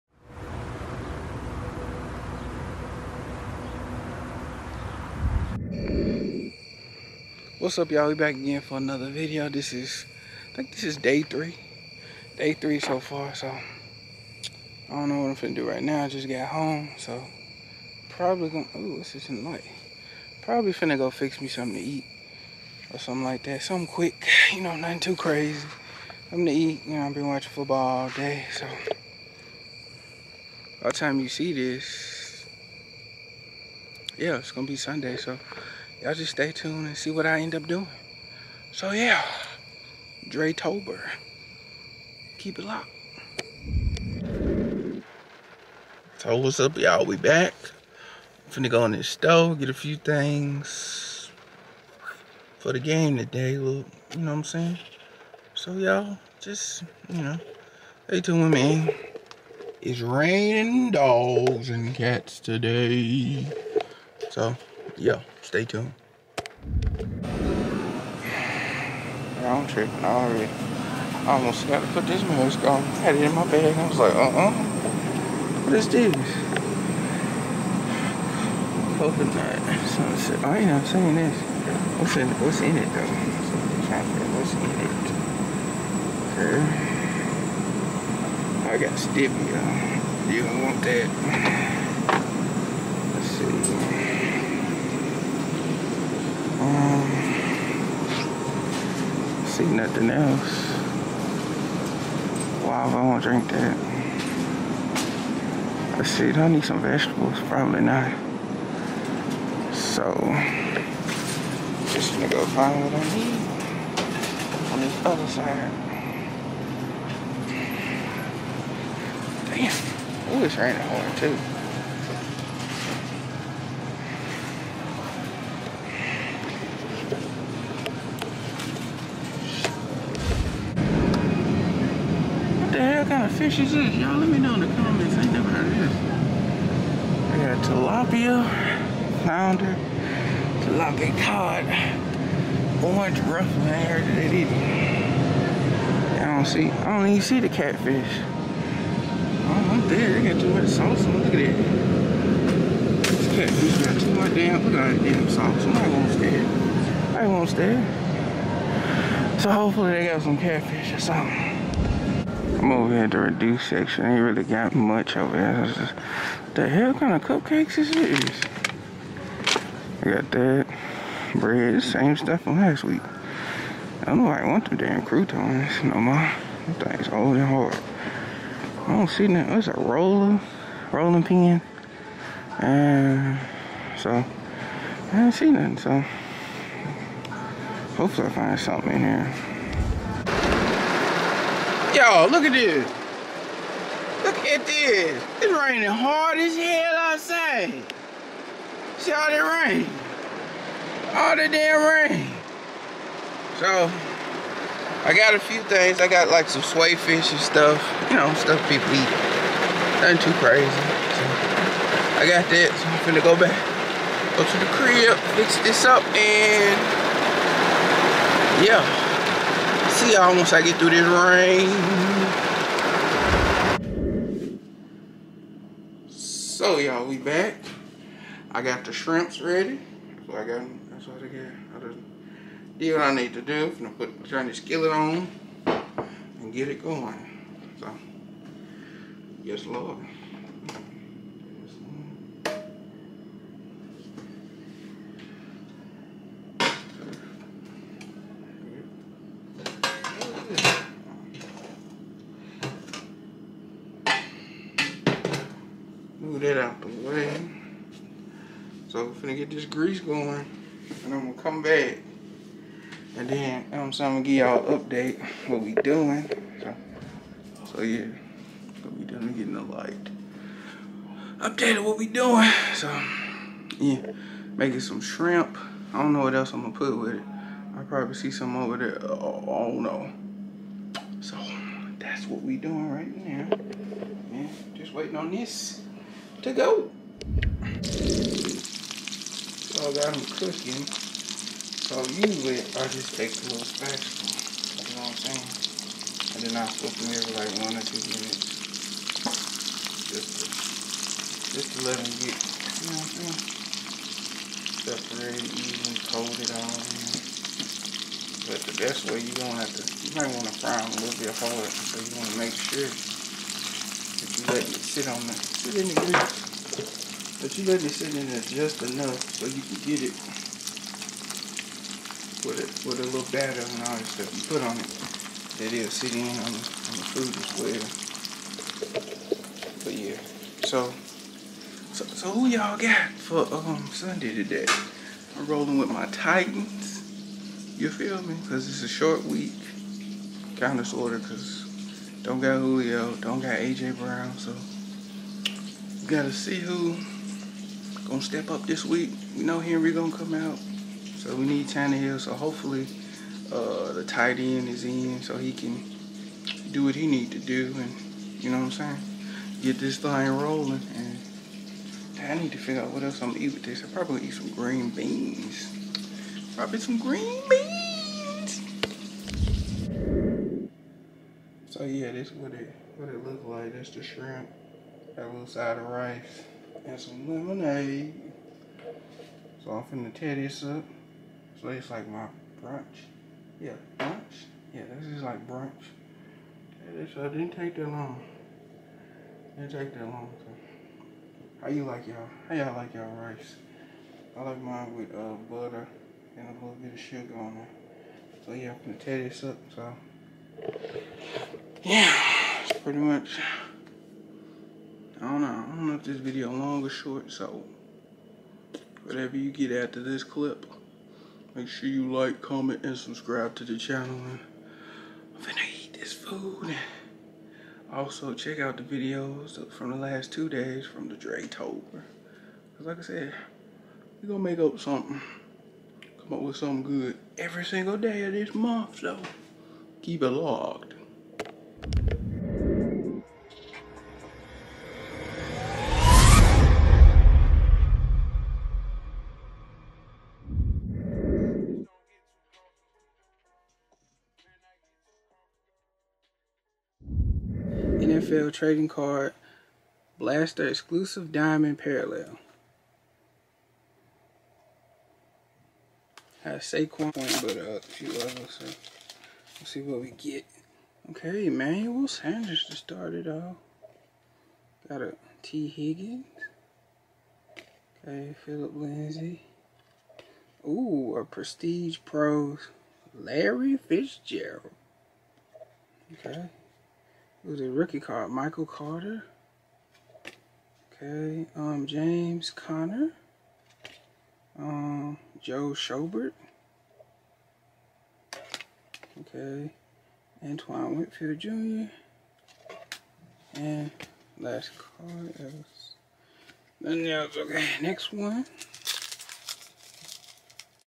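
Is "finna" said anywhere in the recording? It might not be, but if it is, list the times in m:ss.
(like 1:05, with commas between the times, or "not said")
0:20, 0:48, 3:33, 4:19, 6:19, 6:55.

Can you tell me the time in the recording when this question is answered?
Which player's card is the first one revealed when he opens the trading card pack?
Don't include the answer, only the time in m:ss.
7:41.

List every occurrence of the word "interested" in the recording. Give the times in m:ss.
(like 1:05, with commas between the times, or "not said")
not said.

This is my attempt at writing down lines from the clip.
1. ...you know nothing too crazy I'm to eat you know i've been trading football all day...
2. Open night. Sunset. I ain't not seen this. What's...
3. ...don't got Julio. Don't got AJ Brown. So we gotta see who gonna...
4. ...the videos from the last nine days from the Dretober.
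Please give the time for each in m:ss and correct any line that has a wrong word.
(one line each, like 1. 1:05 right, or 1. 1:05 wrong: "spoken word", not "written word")
1. 0:24 wrong: "watching", not "trading"
2. 1:19 right
3. 5:42 right
4. 6:58 wrong: "two", not "nine".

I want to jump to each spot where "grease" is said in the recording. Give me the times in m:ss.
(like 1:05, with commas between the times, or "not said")
4:19, 5:15.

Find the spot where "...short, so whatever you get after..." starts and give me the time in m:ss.
6:46.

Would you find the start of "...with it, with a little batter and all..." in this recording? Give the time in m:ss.
5:22.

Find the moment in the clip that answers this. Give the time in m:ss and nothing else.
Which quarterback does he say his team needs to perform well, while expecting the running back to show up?
5:51.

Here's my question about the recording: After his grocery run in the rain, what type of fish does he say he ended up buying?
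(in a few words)
Swai.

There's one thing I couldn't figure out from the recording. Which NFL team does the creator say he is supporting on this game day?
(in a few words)
Titans.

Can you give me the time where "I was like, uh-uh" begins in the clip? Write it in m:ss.
1:13.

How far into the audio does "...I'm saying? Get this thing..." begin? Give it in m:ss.
5:58.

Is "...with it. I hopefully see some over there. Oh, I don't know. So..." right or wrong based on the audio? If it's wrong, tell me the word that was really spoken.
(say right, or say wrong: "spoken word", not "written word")
wrong: "probably", not "hopefully".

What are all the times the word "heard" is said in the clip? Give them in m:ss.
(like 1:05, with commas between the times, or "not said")
2:15, 2:23.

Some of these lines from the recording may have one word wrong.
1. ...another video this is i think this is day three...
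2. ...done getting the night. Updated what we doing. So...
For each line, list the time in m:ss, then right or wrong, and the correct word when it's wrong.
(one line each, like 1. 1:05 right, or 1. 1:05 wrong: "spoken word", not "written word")
1. 0:08 right
2. 4:29 wrong: "light", not "night".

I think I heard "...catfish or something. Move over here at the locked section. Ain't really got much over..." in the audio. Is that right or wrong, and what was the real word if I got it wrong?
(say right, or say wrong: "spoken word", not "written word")
wrong: "reduced", not "locked".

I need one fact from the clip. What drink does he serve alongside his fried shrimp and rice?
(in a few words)
Lemonade.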